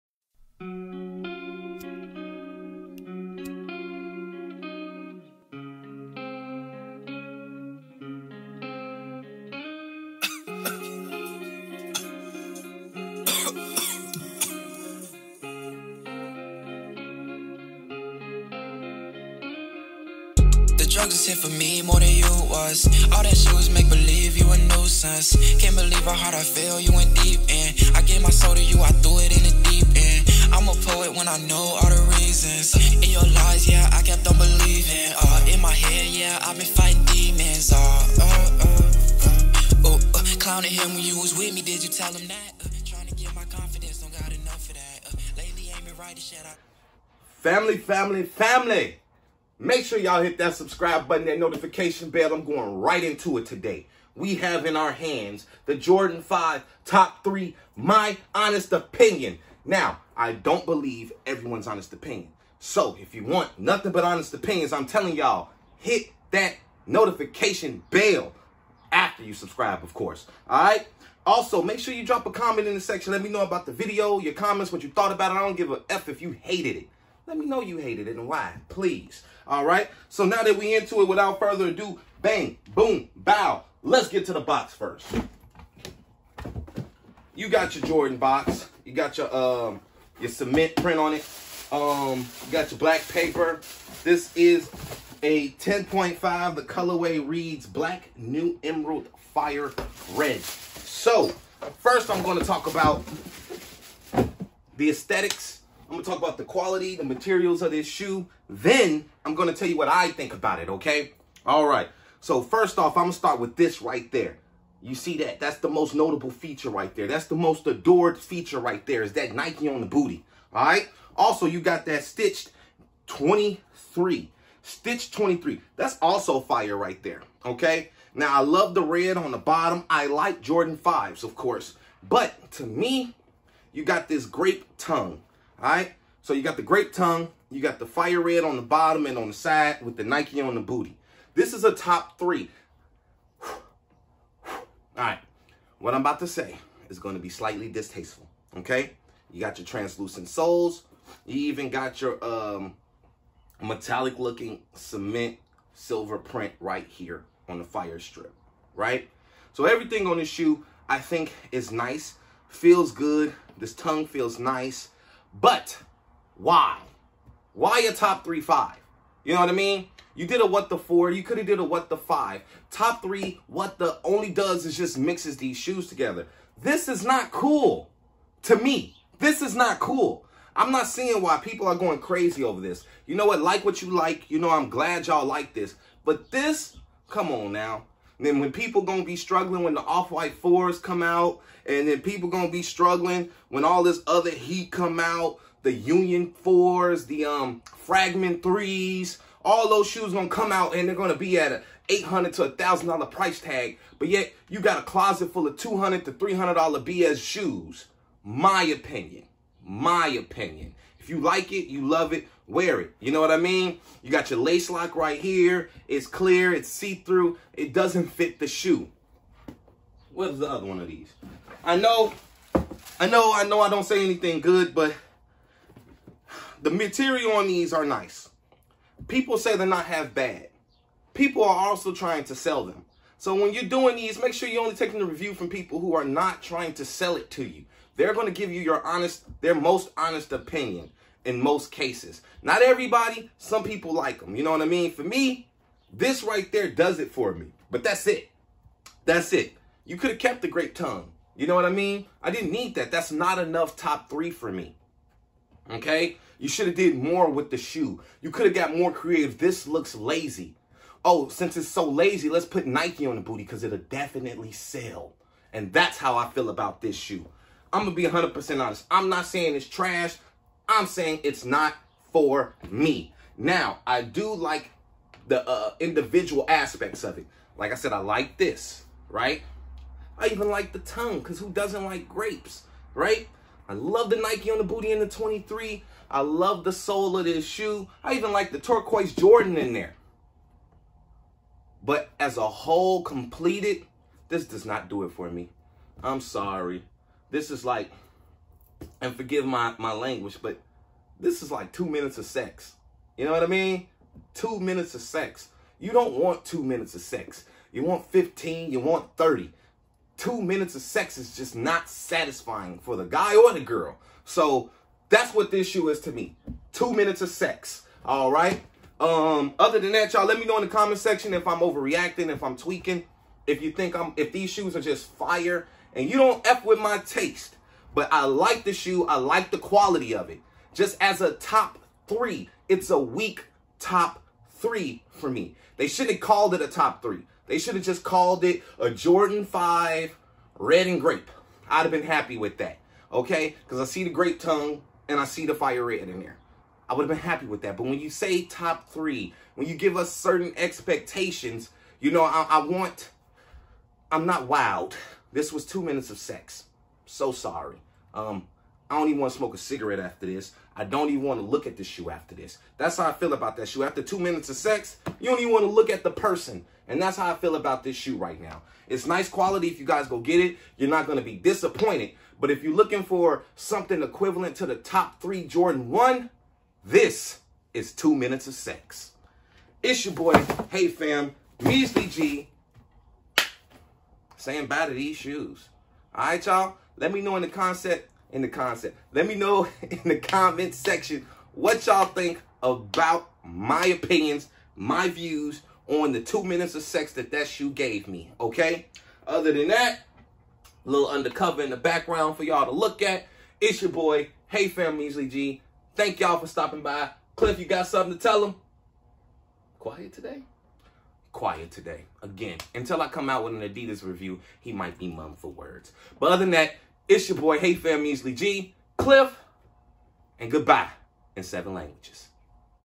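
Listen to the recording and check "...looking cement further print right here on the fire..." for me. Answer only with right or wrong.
wrong.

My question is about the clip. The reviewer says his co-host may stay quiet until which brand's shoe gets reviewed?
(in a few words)
Adidas.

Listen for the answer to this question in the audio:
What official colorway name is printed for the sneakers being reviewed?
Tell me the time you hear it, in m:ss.
1:37.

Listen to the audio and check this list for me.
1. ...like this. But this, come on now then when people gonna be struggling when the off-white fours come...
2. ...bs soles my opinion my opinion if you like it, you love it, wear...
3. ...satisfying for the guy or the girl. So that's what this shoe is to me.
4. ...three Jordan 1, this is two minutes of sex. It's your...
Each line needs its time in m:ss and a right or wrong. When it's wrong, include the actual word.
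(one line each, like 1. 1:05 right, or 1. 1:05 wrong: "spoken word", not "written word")
1. 3:05 right
2. 3:26 wrong: "shoes", not "soles"
3. 5:11 right
4. 6:15 right.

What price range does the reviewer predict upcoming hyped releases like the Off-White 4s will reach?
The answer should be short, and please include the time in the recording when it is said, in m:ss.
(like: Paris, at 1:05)
$800 to $1,000, at 3:21.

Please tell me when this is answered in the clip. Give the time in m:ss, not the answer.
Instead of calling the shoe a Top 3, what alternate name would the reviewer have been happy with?
5:38.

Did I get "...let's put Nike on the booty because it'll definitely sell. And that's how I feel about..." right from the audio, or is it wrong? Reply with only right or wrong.
right.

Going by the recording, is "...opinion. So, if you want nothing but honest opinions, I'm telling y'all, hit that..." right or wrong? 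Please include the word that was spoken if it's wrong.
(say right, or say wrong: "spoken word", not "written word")
right.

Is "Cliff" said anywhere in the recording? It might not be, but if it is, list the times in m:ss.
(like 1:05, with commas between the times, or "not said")
6:47, 6:58.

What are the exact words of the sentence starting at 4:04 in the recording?
For me, this right there does it for me.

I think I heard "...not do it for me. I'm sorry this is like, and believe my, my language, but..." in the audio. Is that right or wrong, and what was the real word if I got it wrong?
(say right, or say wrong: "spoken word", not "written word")
wrong: "forgive", not "believe".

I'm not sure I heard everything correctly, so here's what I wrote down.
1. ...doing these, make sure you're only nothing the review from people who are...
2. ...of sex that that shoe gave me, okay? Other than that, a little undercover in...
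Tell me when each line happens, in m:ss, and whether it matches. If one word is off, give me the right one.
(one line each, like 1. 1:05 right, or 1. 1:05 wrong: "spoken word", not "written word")
1. 3:53 wrong: "taking", not "nothing"
2. 6:36 right.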